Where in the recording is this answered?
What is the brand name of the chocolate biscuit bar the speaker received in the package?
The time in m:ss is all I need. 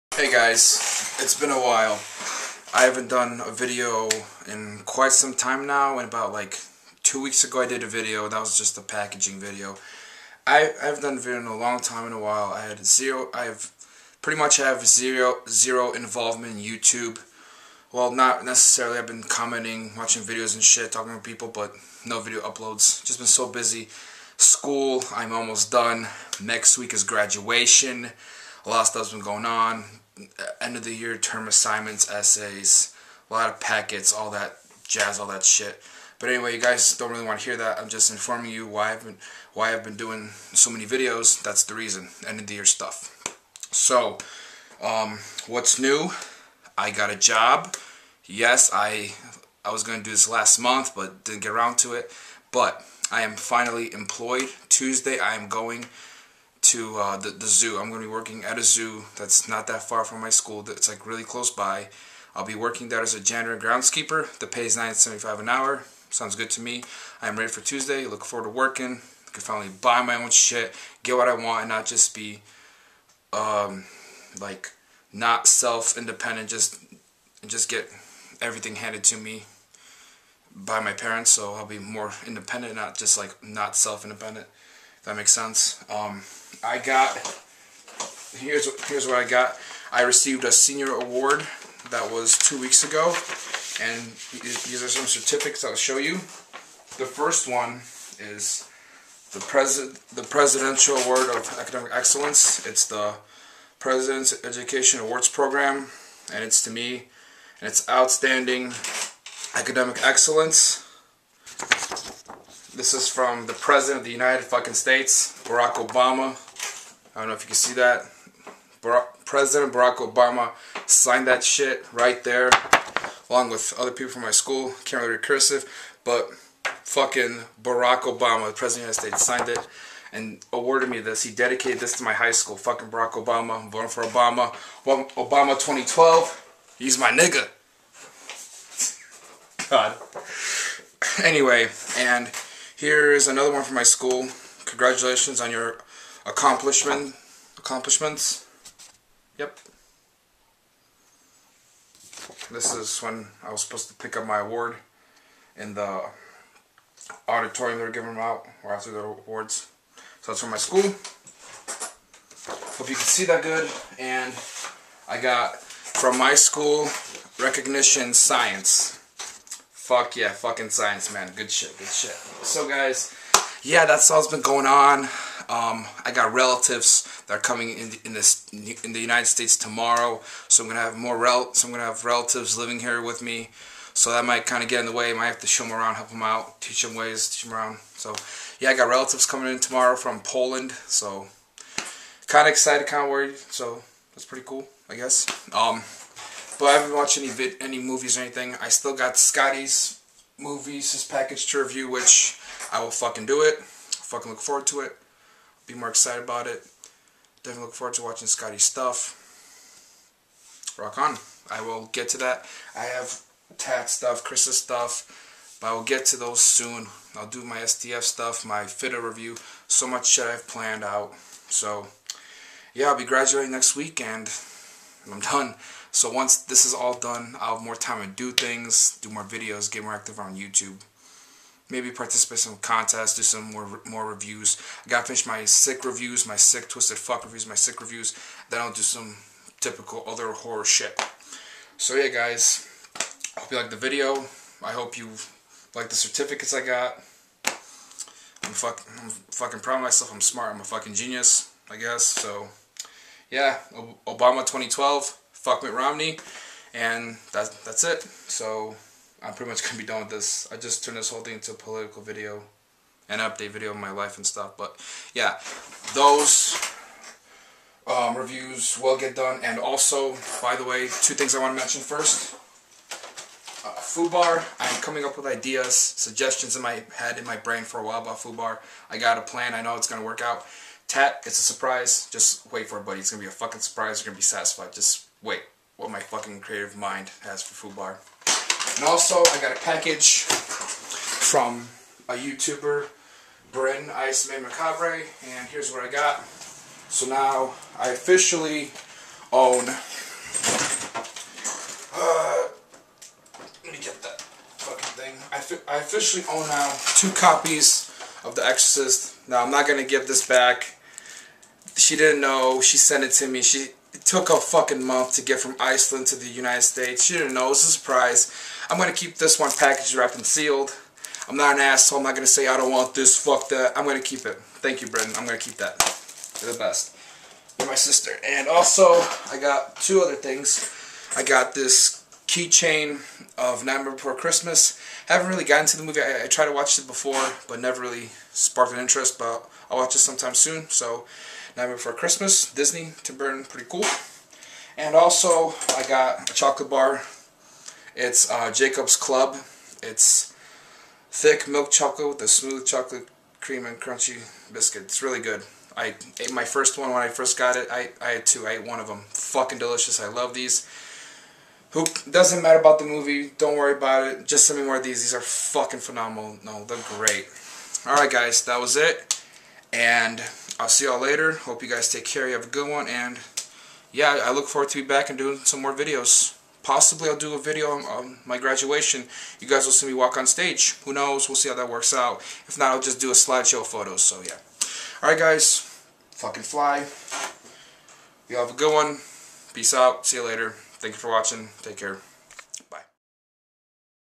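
5:48.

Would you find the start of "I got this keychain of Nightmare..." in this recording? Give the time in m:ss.
5:31.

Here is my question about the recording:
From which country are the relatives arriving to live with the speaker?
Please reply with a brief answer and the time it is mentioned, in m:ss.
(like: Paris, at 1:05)
Poland, at 3:10.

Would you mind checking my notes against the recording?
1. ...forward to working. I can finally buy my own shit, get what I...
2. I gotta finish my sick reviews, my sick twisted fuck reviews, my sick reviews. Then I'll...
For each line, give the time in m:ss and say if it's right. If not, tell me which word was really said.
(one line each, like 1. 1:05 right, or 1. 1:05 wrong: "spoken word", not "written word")
1. 1:08 right
2. 3:54 right.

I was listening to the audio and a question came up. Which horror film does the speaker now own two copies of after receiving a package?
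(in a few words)
The Exorcist.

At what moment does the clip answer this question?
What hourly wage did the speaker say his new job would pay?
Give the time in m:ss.
1:04.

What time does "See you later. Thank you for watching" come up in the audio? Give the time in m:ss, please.
6:30.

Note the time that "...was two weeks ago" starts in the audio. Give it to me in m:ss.
1:32.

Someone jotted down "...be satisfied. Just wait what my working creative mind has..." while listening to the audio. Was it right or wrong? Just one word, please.
wrong.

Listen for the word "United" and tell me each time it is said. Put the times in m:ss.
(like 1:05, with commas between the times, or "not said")
1:54, 2:09, 2:58, 5:16.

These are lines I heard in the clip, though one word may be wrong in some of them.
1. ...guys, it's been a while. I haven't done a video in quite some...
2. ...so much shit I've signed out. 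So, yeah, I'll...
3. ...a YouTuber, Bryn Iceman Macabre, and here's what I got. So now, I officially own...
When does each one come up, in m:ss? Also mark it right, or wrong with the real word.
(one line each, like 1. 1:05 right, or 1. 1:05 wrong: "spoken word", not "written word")
1. 0:00 right
2. 3:39 wrong: "planned", not "signed"
3. 4:52 right.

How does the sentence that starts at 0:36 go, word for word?
But anyway, you guys don't really want to hear that.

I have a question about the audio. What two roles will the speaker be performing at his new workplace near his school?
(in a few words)
janitor and groundskeeper.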